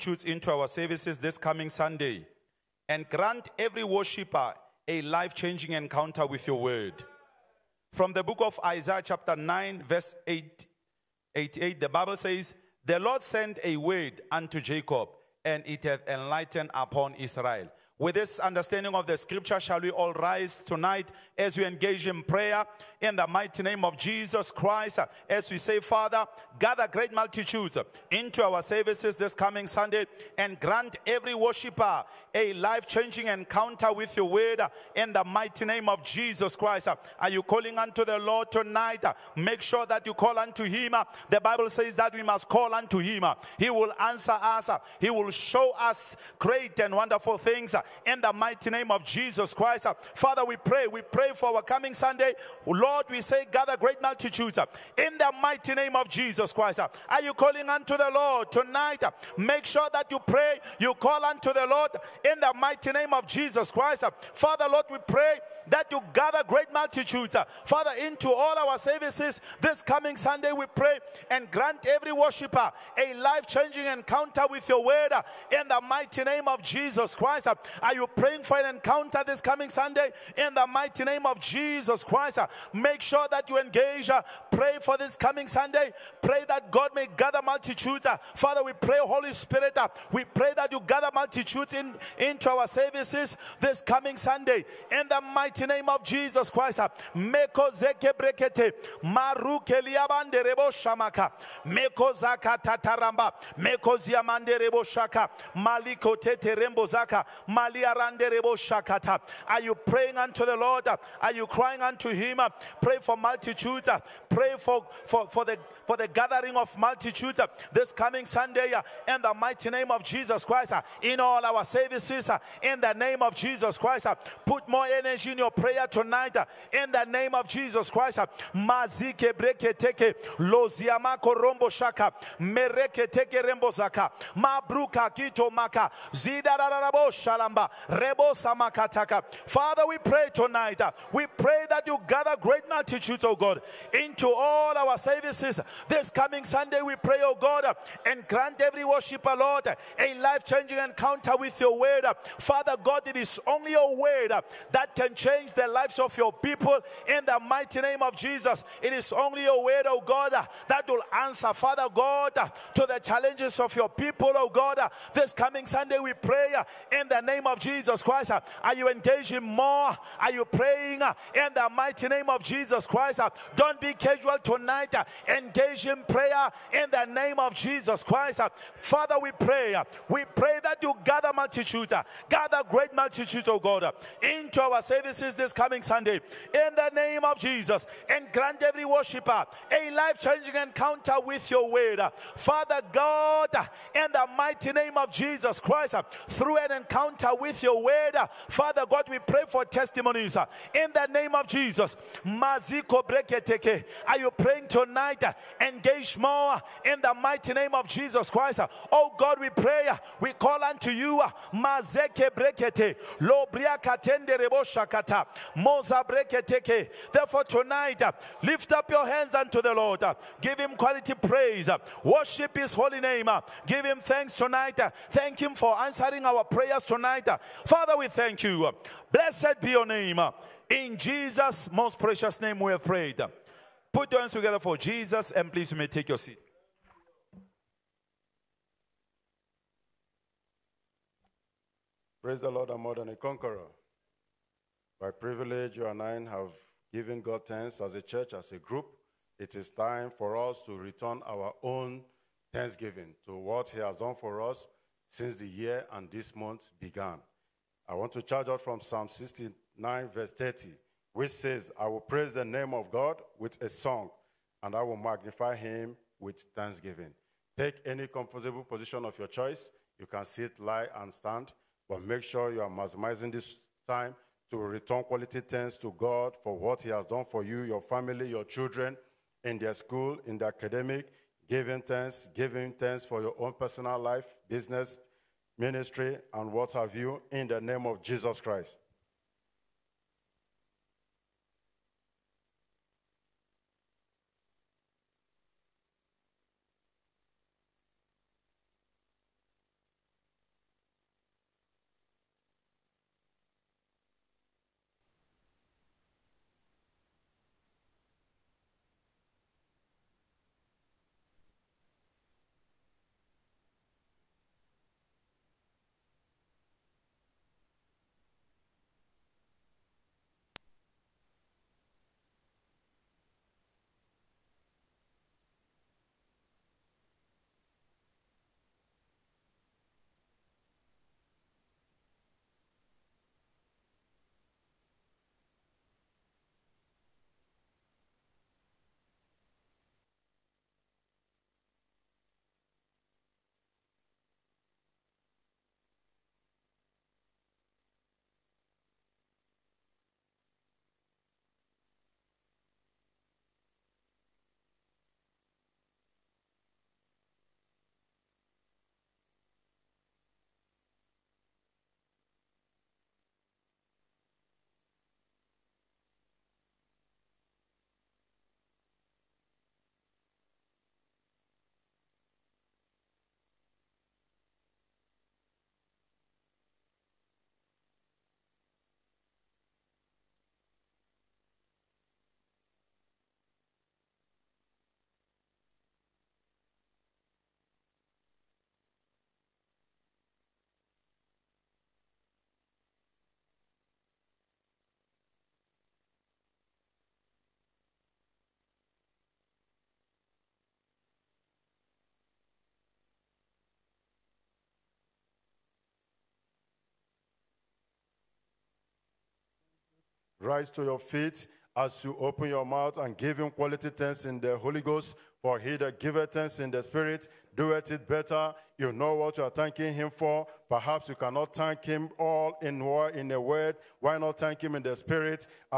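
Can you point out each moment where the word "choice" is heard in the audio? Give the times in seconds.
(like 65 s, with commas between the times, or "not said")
269 s.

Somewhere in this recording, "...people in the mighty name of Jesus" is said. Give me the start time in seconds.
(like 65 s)
156 s.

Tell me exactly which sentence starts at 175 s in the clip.
Engage supplication prayer in the name of Jesus Christ.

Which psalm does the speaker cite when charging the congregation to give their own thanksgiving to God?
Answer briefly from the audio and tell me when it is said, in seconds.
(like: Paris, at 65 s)
Psalm 69, at 258 s.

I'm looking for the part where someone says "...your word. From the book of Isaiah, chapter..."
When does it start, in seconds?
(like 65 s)
6 s.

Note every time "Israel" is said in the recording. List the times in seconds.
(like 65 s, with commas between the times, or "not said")
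17 s.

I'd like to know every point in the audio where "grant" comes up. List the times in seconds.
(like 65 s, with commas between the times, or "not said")
3 s, 30 s, 71 s, 148 s, 188 s.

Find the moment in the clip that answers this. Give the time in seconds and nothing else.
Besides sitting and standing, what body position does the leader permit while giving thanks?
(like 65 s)
270 s.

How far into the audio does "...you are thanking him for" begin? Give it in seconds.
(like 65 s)
419 s.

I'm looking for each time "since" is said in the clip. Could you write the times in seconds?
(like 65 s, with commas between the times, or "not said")
255 s.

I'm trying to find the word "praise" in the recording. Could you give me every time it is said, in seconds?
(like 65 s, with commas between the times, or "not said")
221 s, 242 s, 261 s.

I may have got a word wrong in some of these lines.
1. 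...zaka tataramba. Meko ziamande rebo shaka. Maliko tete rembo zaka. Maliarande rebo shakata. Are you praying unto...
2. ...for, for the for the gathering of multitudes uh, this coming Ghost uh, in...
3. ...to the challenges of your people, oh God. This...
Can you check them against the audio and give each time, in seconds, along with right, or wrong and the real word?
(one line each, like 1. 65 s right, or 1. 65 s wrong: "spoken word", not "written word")
1. 102 s right
2. 115 s wrong: "Sunday", not "Ghost"
3. 162 s right.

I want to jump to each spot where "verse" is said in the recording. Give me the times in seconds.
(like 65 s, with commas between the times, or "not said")
9 s, 260 s.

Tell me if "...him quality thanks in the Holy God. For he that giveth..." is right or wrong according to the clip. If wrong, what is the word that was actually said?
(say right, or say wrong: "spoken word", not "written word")
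wrong: "Ghost", not "God".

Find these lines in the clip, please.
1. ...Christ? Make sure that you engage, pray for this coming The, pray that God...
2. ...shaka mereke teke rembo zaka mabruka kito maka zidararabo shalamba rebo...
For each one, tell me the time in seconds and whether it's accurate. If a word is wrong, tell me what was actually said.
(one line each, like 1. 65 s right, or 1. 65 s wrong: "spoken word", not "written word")
1. 82 s wrong: "Sunday", not "The"
2. 131 s right.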